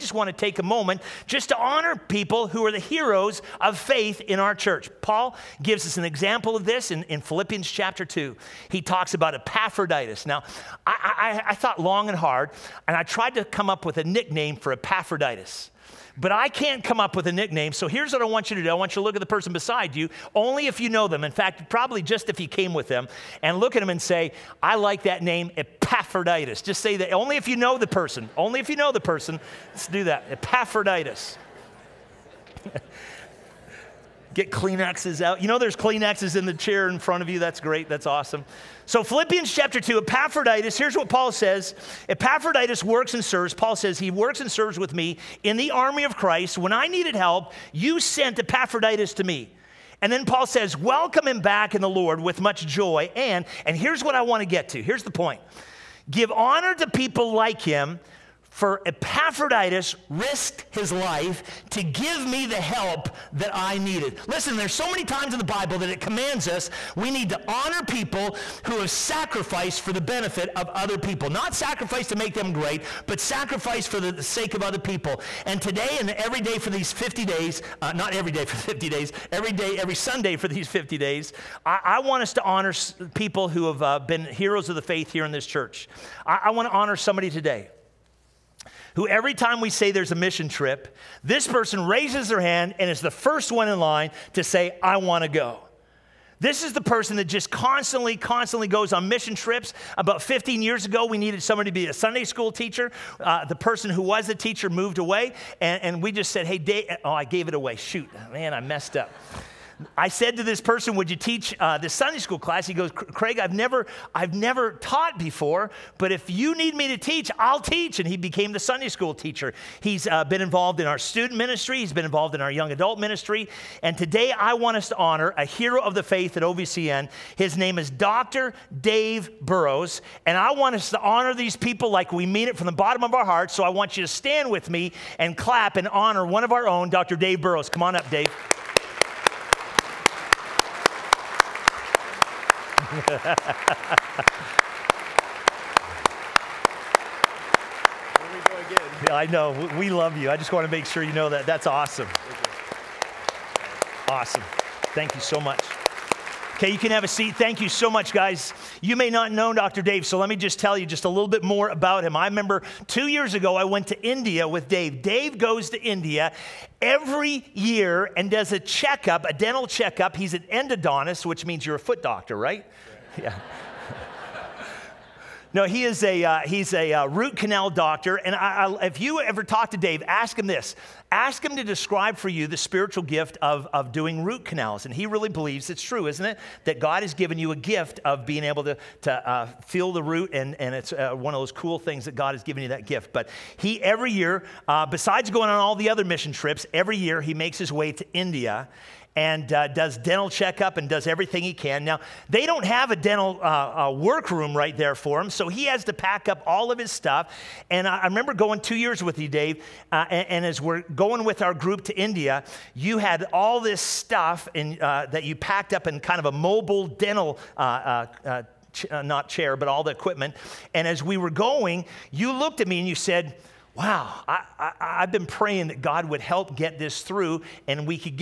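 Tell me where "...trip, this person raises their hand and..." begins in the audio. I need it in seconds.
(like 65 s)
90 s.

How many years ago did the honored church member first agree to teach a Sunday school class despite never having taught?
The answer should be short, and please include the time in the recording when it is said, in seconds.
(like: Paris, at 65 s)
15, at 100 s.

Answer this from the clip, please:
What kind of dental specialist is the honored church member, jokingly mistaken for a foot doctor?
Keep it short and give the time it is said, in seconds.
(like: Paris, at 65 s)
Endodontist, at 170 s.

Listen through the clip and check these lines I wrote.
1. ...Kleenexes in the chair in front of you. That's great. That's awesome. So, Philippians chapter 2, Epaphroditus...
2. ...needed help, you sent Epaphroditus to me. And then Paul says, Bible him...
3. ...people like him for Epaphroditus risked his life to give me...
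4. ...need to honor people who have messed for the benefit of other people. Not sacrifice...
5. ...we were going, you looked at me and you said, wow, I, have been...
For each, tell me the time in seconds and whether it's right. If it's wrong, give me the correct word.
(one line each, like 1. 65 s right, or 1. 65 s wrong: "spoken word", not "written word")
1. 35 s right
2. 46 s wrong: "Welcome", not "Bible"
3. 56 s right
4. 67 s wrong: "sacrificed", not "messed"
5. 221 s right.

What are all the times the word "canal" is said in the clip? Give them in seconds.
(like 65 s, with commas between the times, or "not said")
177 s, 184 s.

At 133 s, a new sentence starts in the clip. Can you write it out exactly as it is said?
So I want you to stand with me and clap and honor one of our own, Dr.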